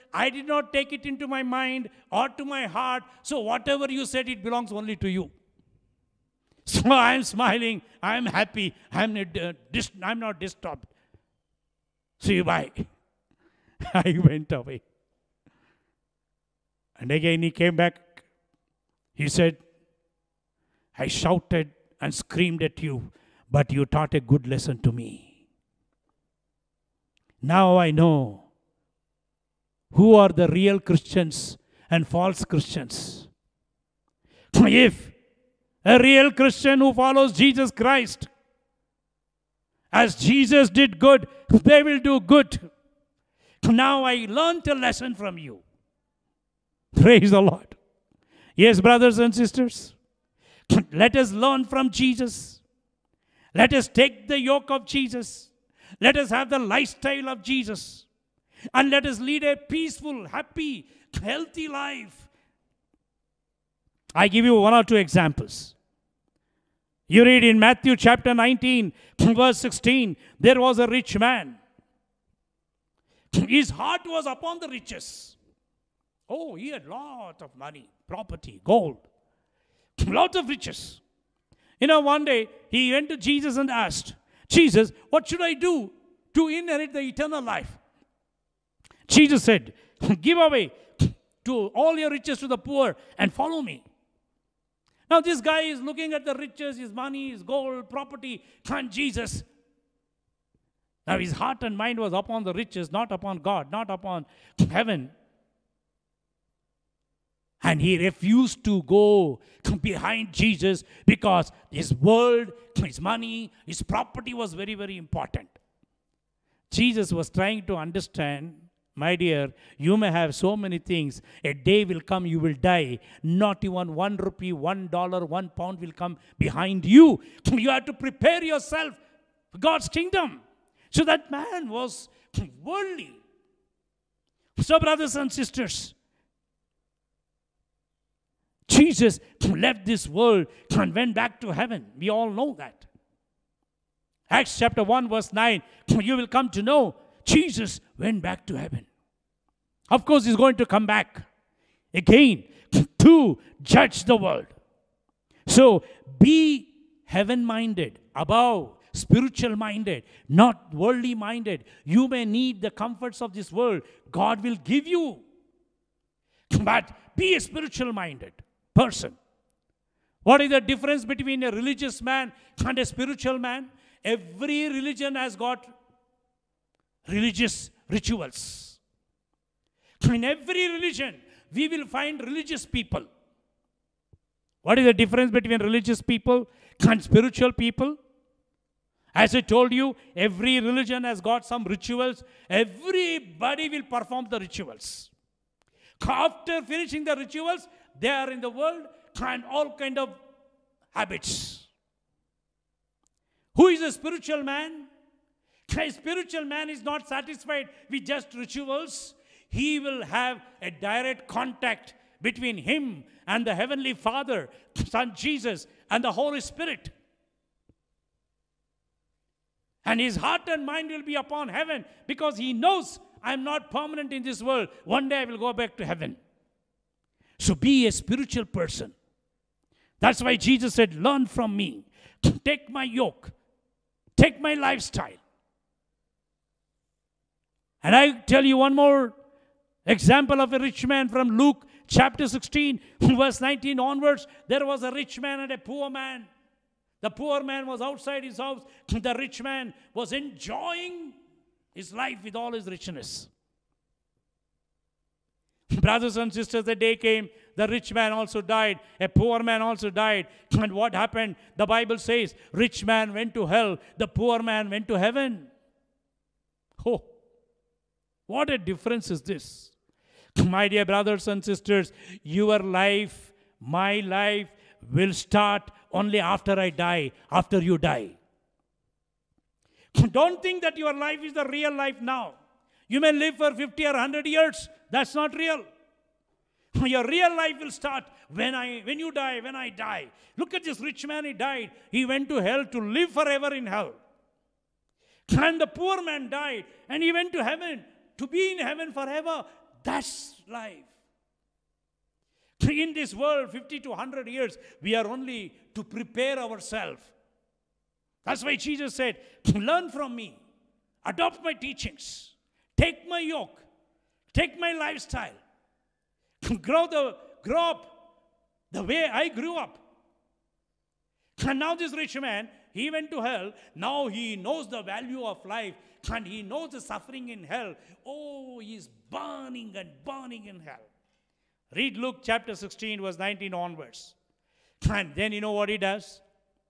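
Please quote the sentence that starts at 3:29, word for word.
He will have a direct contact between him and the Heavenly Father, Son Jesus, and the Holy Spirit.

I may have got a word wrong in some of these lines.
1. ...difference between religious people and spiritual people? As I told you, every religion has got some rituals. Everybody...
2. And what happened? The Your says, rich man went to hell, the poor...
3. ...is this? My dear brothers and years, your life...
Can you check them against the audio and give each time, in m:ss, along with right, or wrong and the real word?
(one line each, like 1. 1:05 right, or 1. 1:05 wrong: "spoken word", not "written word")
1. 3:04 right
2. 4:20 wrong: "Bible", not "Your"
3. 4:29 wrong: "sisters", not "years".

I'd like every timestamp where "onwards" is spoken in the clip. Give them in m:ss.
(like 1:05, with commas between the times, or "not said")
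4:03, 5:33.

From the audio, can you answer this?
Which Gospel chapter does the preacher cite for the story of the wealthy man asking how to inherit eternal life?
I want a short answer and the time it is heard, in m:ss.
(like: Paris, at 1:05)
Matthew 19, at 1:07.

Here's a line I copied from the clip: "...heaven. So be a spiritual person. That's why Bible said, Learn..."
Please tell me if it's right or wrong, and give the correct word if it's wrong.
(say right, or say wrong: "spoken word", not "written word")
wrong: "Jesus", not "Bible".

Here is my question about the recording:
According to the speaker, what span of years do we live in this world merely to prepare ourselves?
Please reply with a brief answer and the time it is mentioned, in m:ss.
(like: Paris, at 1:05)
50 to 100 years, at 5:03.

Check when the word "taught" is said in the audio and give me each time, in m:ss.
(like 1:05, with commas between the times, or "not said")
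0:23.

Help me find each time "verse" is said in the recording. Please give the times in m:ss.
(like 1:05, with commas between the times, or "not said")
1:09, 2:25, 4:03, 5:33.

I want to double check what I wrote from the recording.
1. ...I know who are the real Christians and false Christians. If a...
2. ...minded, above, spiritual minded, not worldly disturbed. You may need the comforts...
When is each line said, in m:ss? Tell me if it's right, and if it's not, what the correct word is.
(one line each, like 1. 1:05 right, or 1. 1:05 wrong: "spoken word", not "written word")
1. 0:27 right
2. 2:37 wrong: "minded", not "disturbed".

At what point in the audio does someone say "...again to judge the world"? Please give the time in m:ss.
2:31.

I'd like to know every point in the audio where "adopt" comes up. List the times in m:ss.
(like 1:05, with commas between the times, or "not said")
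5:11.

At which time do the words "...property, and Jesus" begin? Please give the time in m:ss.
1:37.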